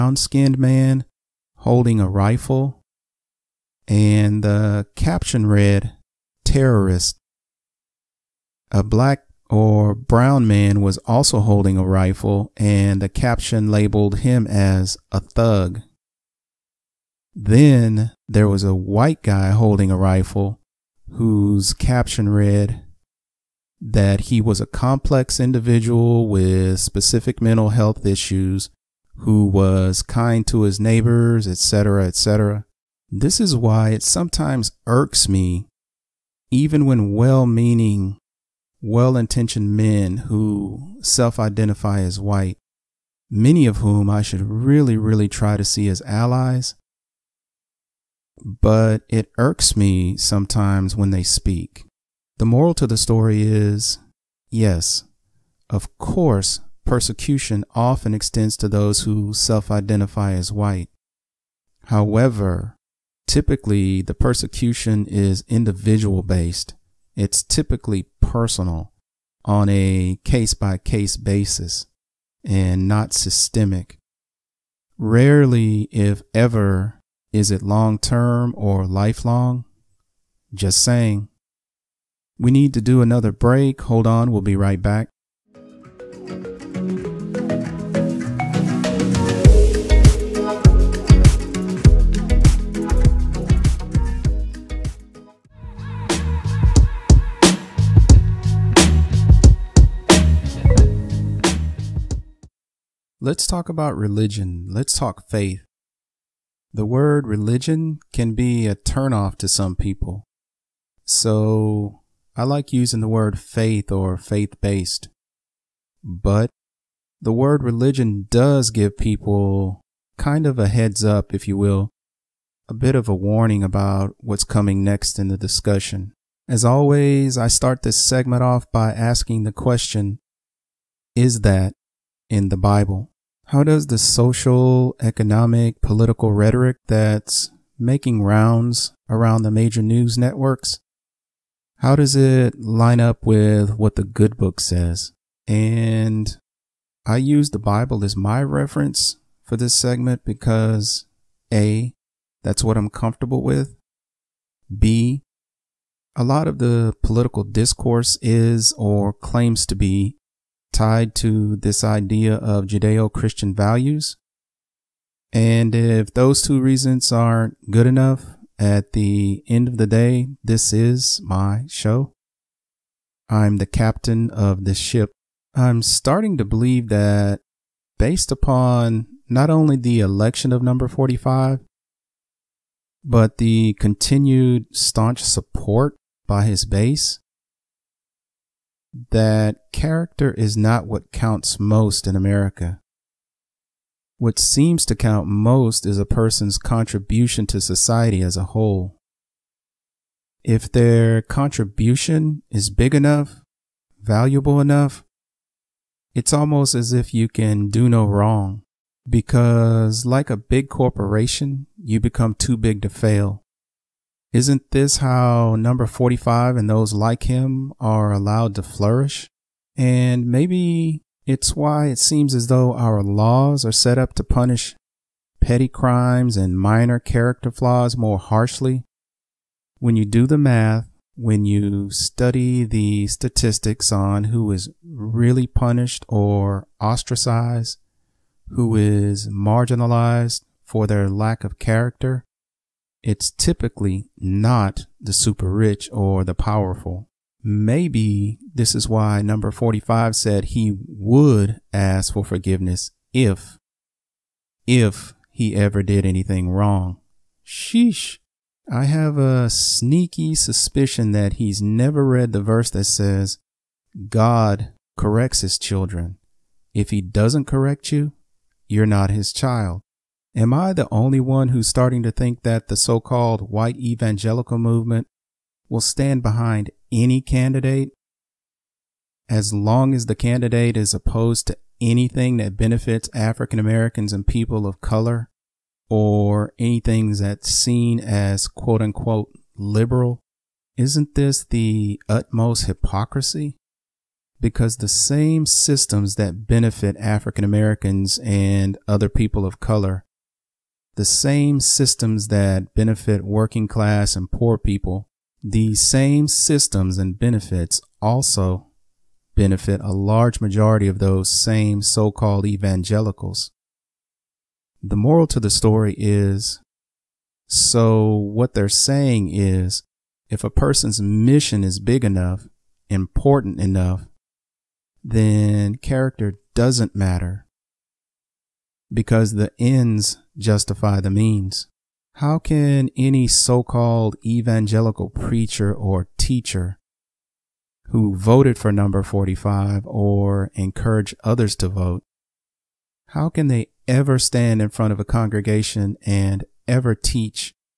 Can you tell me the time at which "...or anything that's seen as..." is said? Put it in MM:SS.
04:45.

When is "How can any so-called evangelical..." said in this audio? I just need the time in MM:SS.
05:32.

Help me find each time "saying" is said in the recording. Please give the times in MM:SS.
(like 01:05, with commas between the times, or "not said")
01:20, 05:18.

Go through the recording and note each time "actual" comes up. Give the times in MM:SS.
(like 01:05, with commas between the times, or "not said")
not said.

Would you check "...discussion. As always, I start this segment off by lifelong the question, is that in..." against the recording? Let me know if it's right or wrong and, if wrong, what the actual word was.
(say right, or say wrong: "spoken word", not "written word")
wrong: "asking", not "lifelong".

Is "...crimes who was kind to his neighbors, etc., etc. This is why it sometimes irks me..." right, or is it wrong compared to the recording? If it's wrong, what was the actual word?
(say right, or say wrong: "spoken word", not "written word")
wrong: "issues", not "crimes".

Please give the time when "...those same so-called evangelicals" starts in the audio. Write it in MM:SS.
05:10.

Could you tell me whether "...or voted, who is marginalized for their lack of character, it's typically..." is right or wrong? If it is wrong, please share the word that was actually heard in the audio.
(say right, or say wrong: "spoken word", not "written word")
wrong: "ostracized", not "voted".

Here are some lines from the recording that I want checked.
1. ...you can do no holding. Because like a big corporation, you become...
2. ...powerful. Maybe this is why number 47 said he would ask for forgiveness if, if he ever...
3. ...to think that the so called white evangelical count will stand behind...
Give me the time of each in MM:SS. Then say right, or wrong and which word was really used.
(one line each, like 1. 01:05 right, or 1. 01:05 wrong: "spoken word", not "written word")
1. 03:27 wrong: "wrong", not "holding"
2. 04:06 wrong: "45", not "47"
3. 04:32 wrong: "movement", not "count".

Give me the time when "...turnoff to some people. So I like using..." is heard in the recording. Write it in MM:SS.
01:48.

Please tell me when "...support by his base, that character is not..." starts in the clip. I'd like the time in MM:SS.
03:05.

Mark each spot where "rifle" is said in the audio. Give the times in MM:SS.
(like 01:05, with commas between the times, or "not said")
00:02, 00:11, 00:19.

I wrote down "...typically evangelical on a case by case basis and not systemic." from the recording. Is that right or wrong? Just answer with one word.
wrong.